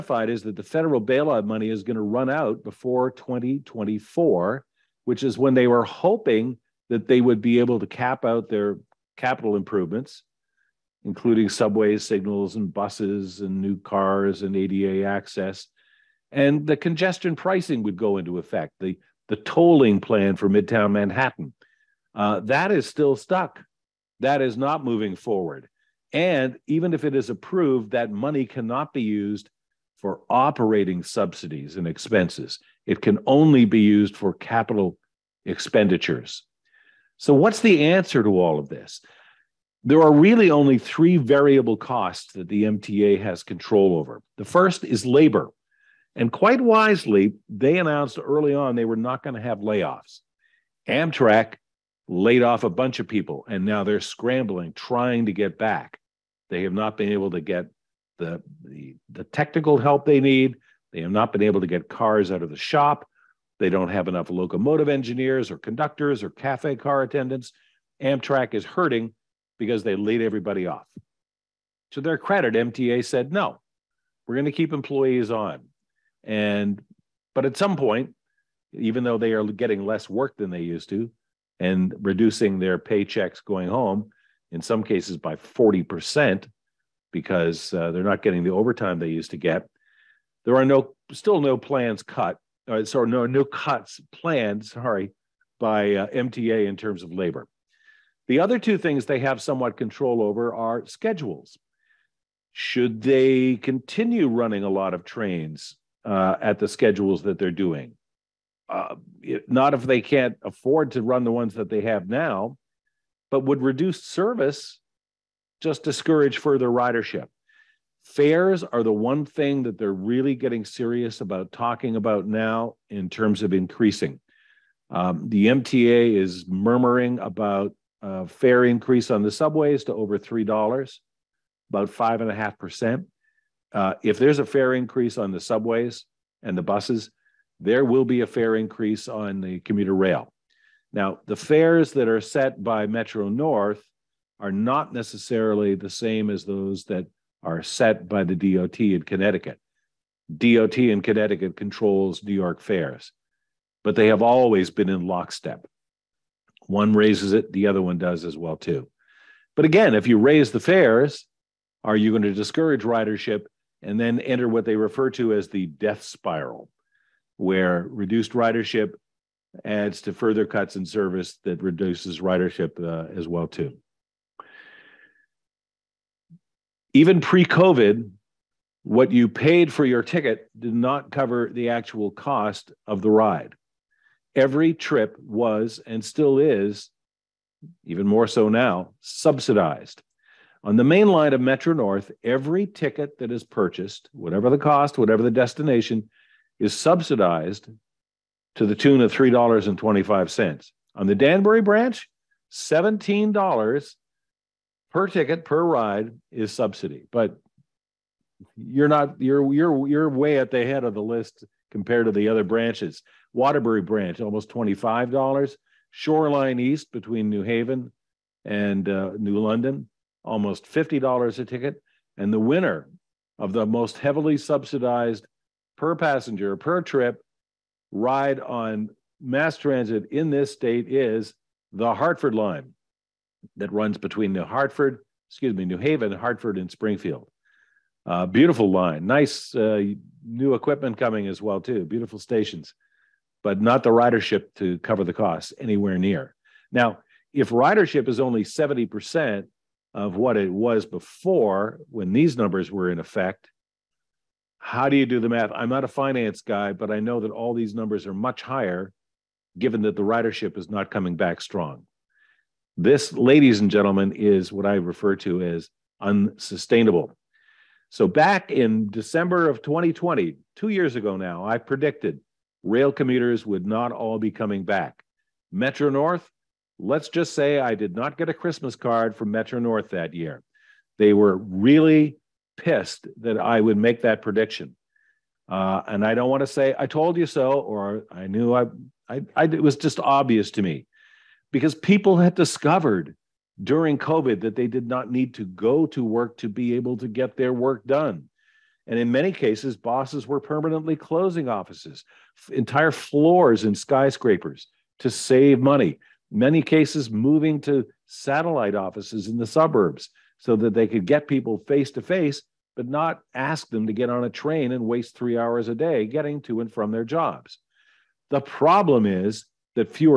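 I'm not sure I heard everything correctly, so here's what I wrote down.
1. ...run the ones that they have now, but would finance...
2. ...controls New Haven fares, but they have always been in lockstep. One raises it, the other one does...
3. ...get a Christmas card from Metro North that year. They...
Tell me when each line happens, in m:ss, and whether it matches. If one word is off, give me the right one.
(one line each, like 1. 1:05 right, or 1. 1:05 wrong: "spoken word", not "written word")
1. 1:51 wrong: "reduce", not "finance"
2. 2:31 wrong: "York", not "Haven"
3. 4:38 right.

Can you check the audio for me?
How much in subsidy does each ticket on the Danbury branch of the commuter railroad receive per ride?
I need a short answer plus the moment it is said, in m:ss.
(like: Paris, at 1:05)
$17, at 3:22.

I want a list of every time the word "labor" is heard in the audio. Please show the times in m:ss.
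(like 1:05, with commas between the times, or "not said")
0:45, 1:37.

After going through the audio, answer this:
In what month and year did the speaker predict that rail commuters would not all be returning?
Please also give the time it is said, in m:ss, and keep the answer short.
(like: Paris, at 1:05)
December 2020, at 4:28.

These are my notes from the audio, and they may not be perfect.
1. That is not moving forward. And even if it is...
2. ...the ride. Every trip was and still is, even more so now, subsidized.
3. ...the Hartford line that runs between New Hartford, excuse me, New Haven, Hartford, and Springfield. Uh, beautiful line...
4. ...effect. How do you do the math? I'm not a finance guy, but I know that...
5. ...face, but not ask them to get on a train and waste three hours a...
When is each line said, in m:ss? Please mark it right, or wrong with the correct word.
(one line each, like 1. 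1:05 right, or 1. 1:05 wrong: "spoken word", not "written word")
1. 0:24 right
2. 3:03 right
3. 3:51 right
4. 4:12 right
5. 5:12 right.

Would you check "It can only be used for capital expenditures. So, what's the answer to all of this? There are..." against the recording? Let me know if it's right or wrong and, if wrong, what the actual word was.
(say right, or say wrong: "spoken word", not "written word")
right.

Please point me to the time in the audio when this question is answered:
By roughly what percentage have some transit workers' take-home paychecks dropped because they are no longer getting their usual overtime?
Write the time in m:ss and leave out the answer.
1:25.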